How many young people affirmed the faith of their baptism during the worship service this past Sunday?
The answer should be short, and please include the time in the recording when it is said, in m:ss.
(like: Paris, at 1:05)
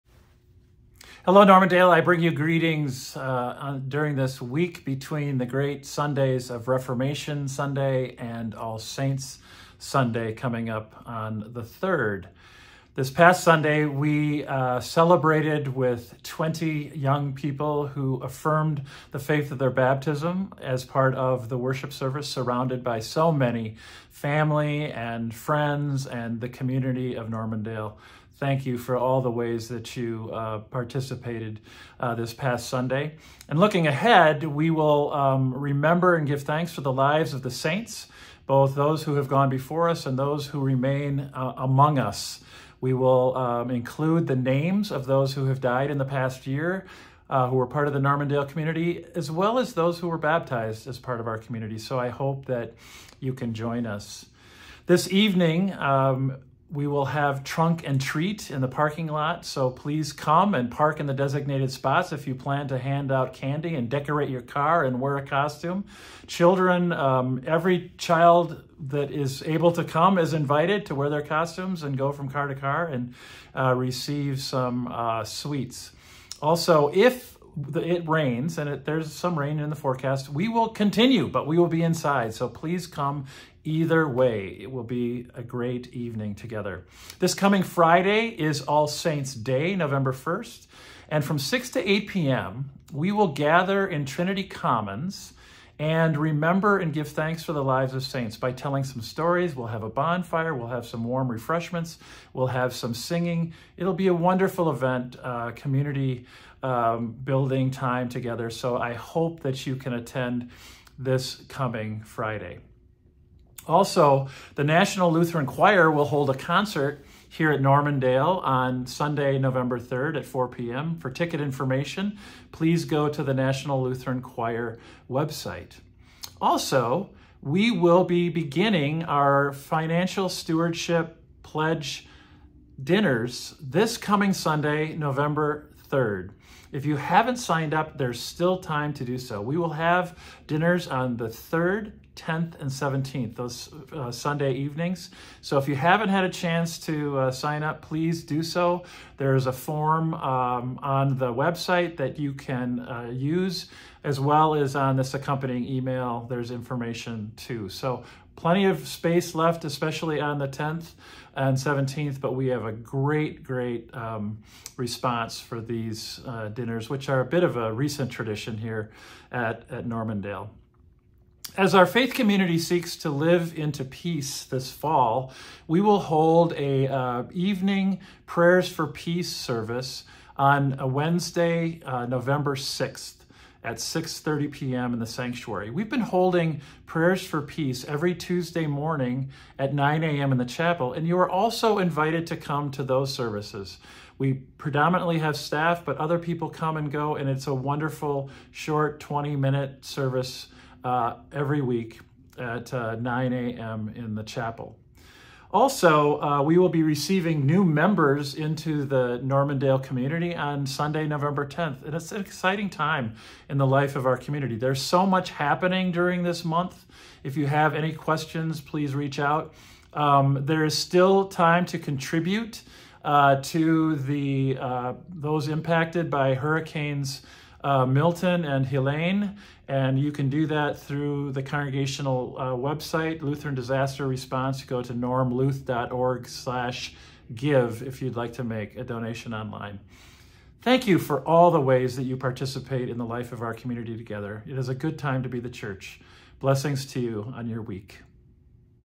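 20, at 0:16.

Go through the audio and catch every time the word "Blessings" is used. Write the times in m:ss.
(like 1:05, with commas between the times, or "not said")
4:06.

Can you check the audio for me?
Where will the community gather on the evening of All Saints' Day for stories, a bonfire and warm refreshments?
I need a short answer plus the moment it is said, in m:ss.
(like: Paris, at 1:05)
Trinity Commons, at 1:34.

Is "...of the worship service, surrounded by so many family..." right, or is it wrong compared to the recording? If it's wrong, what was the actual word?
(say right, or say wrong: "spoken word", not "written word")
right.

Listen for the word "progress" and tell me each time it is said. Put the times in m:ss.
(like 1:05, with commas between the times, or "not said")
not said.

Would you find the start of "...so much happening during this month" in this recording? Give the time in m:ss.
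3:34.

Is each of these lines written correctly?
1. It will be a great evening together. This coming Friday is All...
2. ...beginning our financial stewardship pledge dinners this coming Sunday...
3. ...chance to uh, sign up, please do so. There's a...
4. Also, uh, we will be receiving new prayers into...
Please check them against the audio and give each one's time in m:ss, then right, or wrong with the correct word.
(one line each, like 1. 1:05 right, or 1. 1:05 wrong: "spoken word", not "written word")
1. 1:24 right
2. 2:08 right
3. 2:26 right
4. 3:25 wrong: "members", not "prayers".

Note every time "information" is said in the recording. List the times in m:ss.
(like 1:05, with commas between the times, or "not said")
2:01, 2:36.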